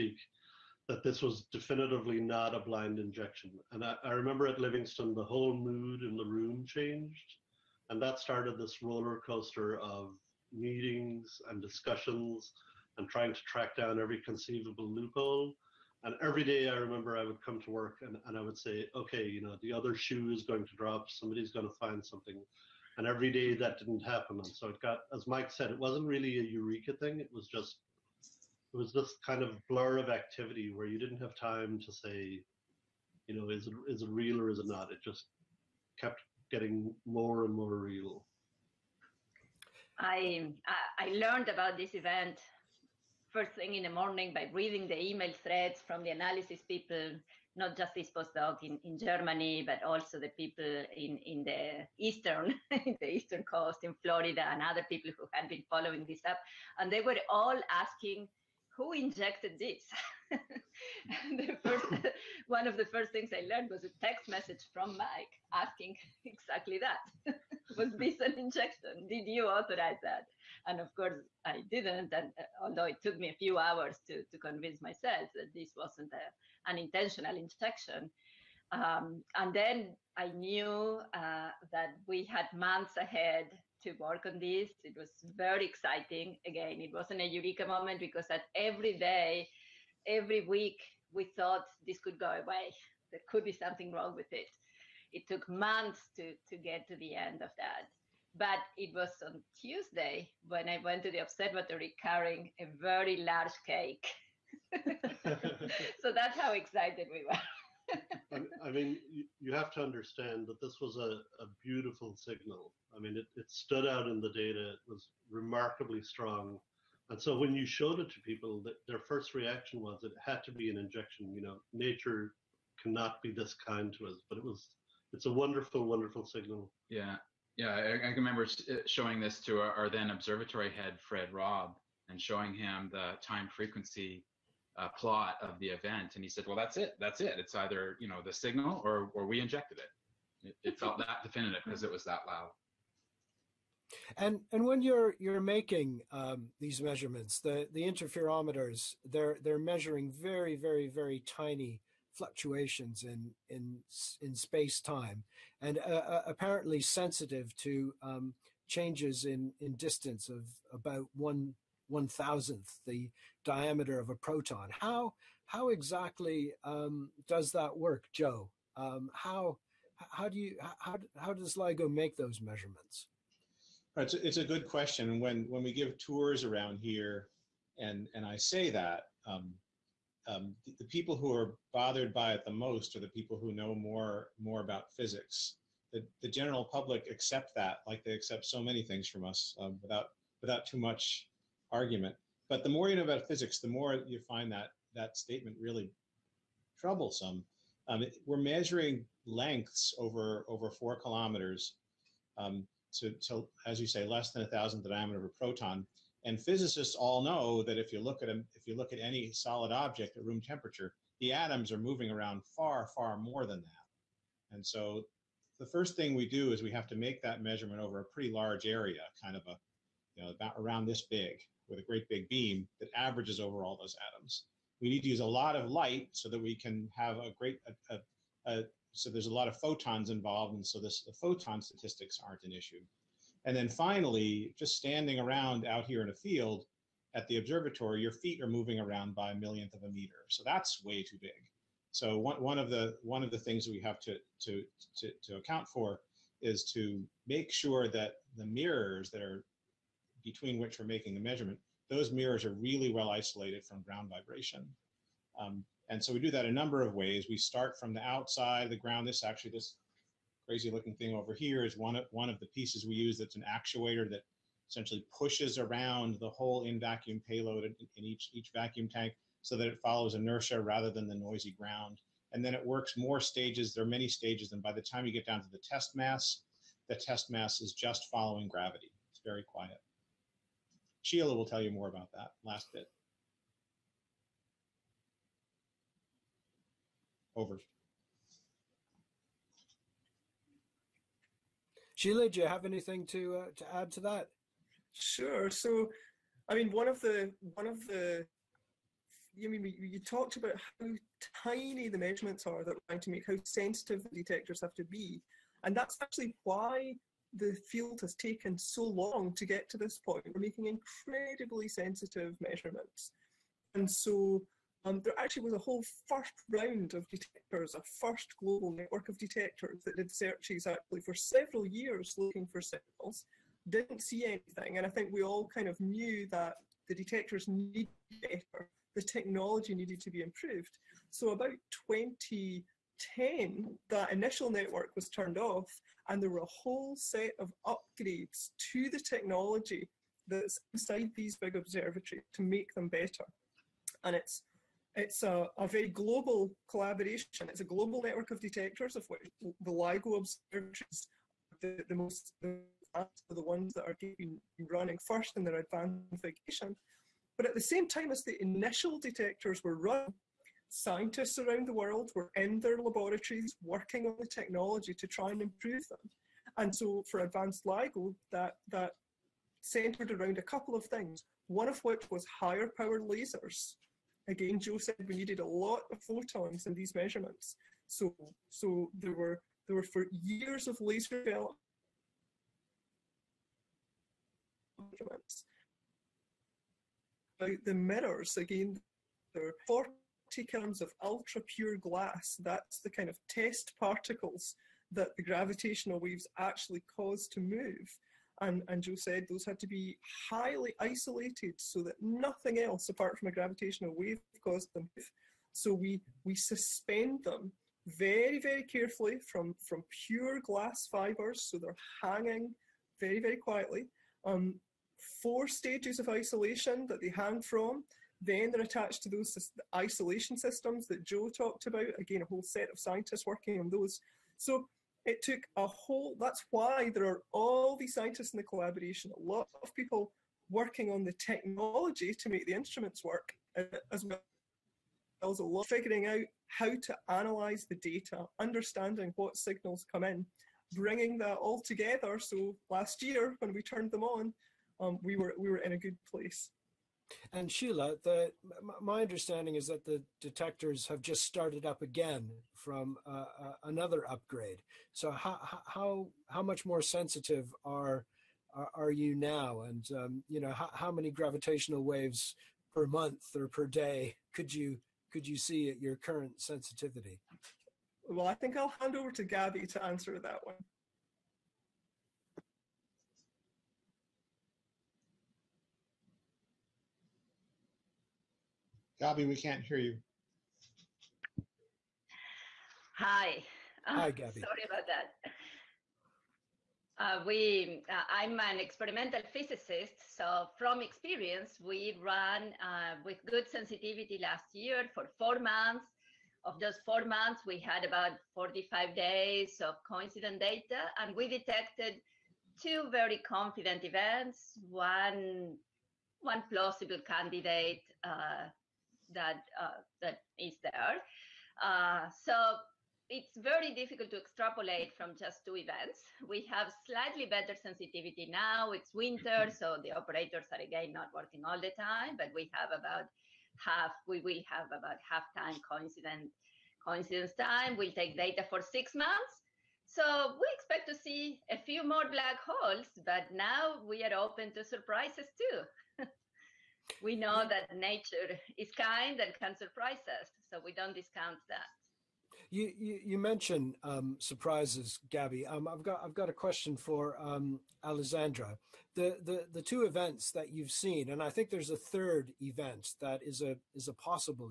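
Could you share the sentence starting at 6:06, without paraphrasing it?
And so for advanced LIGO, that, that centered around a couple of things, one of which was higher power lasers.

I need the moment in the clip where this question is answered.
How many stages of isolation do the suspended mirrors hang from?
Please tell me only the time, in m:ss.
6:55.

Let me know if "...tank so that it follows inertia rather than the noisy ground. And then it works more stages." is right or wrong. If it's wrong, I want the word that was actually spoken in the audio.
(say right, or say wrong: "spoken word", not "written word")
right.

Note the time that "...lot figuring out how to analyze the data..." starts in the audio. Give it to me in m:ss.
7:15.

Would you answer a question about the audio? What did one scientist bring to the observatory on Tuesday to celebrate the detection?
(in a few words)
A very large cake.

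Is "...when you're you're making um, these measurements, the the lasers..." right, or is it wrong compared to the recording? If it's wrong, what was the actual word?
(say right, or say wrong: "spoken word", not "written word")
wrong: "interferometers", not "lasers".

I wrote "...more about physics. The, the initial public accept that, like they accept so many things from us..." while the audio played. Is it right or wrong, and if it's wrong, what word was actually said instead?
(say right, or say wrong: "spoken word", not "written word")
wrong: "general", not "initial".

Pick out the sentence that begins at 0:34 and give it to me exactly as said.
It just kept getting more and more real.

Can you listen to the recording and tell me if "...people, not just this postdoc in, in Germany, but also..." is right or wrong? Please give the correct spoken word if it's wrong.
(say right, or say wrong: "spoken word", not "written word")
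right.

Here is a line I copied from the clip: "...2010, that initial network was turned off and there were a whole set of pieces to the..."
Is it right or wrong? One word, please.
wrong.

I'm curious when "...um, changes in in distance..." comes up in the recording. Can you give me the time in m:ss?
2:38.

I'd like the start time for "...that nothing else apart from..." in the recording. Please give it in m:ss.
6:41.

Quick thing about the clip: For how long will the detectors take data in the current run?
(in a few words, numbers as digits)
6 months.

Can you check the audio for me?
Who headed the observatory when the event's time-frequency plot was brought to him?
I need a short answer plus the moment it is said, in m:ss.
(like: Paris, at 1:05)
Fred Raab, at 2:11.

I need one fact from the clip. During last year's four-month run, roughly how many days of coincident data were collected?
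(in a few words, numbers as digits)
45.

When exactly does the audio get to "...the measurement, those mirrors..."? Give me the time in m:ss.
4:11.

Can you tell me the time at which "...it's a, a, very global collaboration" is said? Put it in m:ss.
5:44.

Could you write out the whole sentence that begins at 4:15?
Um, and so we do that a number of ways.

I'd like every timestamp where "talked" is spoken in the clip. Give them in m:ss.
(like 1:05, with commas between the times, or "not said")
4:59, 7:01.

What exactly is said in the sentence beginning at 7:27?
And Sheila, the, my understanding is that the detectors have just started up again from uh, uh, another upgrade.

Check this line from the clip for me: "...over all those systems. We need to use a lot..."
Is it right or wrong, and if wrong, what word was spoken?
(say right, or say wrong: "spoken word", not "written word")
wrong: "atoms", not "systems".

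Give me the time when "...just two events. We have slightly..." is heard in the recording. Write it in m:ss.
8:35.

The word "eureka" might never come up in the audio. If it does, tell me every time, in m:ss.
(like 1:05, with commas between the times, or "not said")
0:26, 1:27.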